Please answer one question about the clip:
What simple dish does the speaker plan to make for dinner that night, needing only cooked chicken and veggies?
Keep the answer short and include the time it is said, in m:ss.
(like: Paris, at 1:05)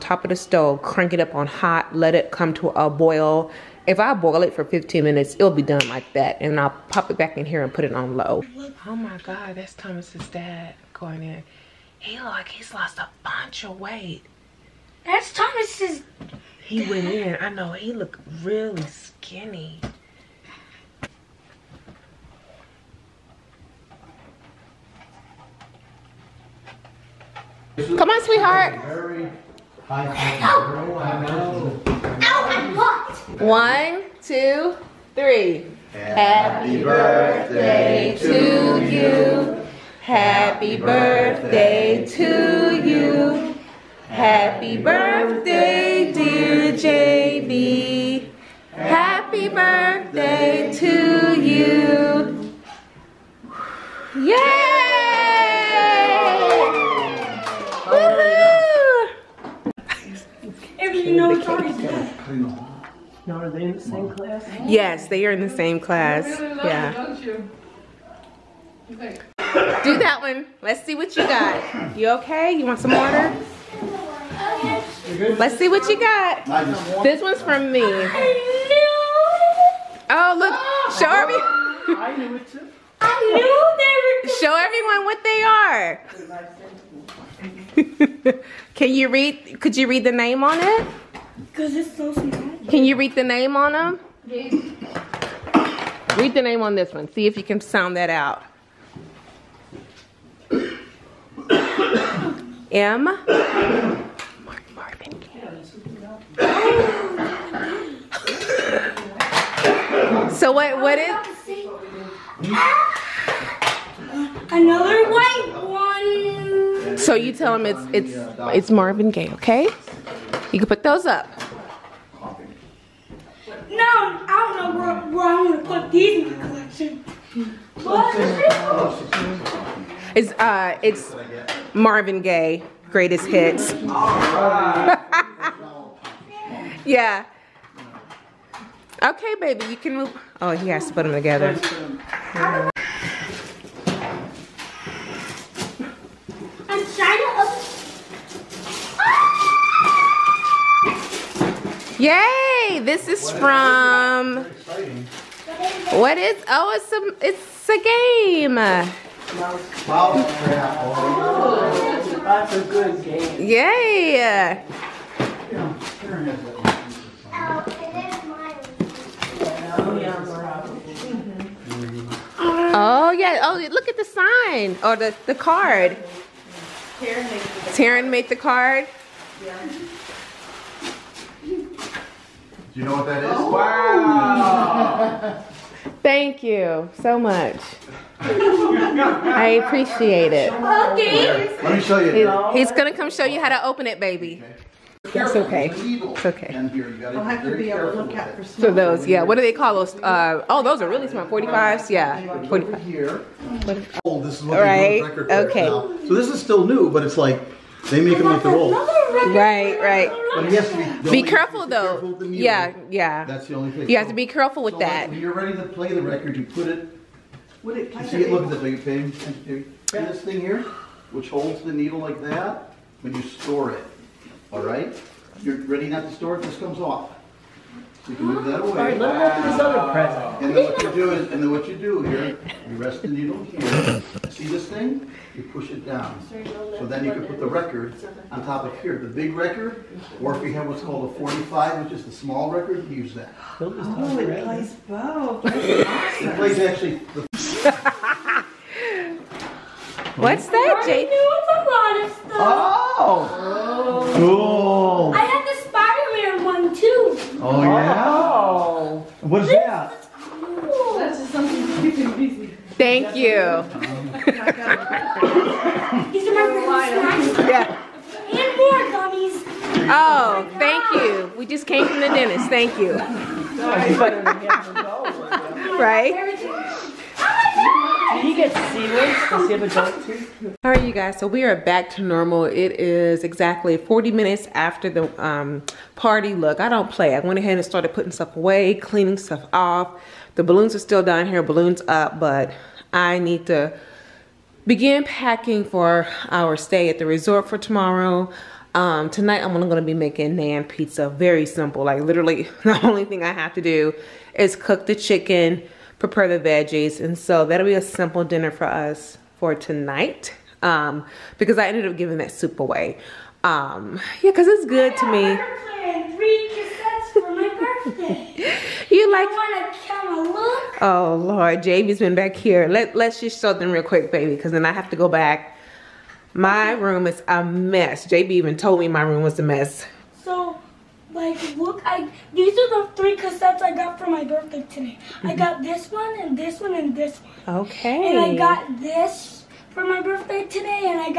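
naan pizza, at 5:00.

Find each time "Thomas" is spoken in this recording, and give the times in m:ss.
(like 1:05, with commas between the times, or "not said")
0:09, 0:15.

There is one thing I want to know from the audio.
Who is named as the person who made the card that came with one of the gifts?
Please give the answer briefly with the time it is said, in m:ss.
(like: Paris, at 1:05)
Taryn, at 2:57.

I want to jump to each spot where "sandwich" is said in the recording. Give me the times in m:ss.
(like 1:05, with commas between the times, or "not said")
4:39.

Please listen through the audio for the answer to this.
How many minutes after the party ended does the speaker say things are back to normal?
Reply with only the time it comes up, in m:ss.
4:43.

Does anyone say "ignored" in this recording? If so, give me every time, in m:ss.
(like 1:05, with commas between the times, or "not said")
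not said.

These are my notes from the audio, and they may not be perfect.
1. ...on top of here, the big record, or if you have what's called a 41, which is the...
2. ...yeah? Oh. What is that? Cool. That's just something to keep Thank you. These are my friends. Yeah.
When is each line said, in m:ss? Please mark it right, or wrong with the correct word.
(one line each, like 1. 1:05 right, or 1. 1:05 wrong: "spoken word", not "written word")
1. 3:58 wrong: "45", not "41"
2. 4:17 right.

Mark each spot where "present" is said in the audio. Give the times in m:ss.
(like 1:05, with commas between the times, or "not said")
3:49.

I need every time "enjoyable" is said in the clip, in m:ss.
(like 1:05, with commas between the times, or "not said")
not said.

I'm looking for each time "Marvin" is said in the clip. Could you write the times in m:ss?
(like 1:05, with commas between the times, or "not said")
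1:43, 1:58, 2:11.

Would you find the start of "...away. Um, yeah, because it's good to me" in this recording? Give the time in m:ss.
5:12.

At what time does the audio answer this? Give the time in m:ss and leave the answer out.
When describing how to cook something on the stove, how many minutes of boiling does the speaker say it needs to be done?
0:04.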